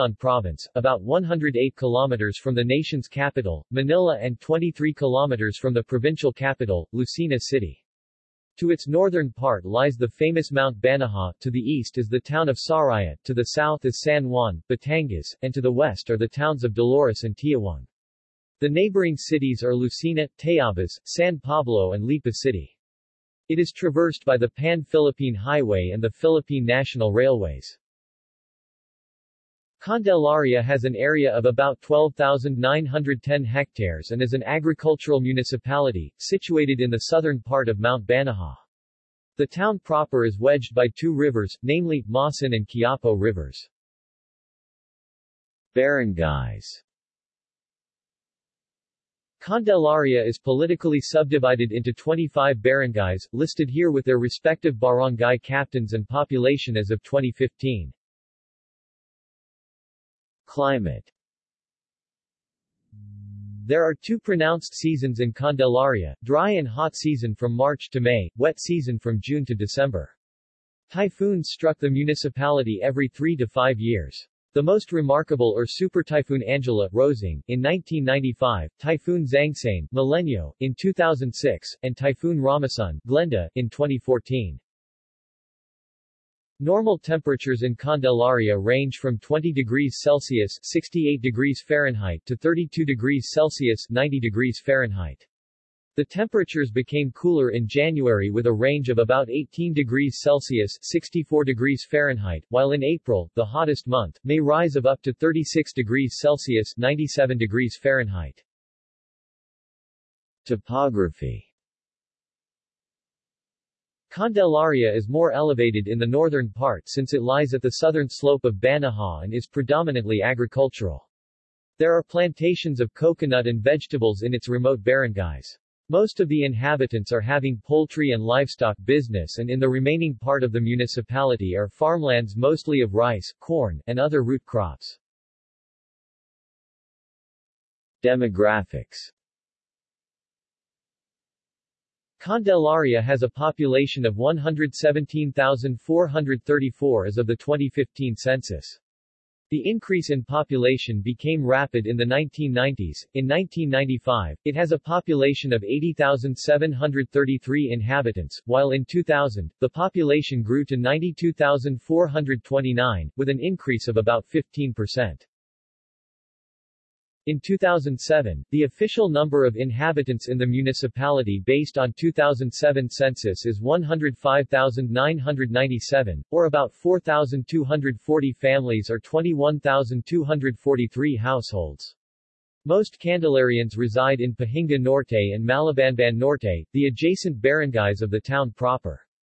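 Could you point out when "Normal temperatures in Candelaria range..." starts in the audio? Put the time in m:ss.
1:26.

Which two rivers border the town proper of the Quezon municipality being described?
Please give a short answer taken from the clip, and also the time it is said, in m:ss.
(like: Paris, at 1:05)
Masan and Quiapo, at 0:42.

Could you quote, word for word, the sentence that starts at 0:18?
The neighboring cities are Lucena, Tayabas, San Pablo and Lipa City.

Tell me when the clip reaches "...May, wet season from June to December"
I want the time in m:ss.
1:07.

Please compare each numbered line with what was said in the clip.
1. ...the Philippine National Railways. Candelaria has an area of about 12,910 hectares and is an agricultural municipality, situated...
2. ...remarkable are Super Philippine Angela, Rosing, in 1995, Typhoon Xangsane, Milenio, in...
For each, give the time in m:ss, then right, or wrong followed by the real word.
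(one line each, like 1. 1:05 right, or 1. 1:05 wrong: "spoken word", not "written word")
1. 0:26 right
2. 1:14 wrong: "Typhoon", not "Philippine".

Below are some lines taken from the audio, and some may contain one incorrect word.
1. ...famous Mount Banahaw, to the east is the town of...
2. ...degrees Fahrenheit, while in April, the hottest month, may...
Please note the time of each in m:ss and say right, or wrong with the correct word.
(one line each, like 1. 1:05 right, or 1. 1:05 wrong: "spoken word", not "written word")
1. 0:10 right
2. 1:41 right.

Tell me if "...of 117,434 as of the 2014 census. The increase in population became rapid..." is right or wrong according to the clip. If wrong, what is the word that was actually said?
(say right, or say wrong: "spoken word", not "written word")
wrong: "2015", not "2014".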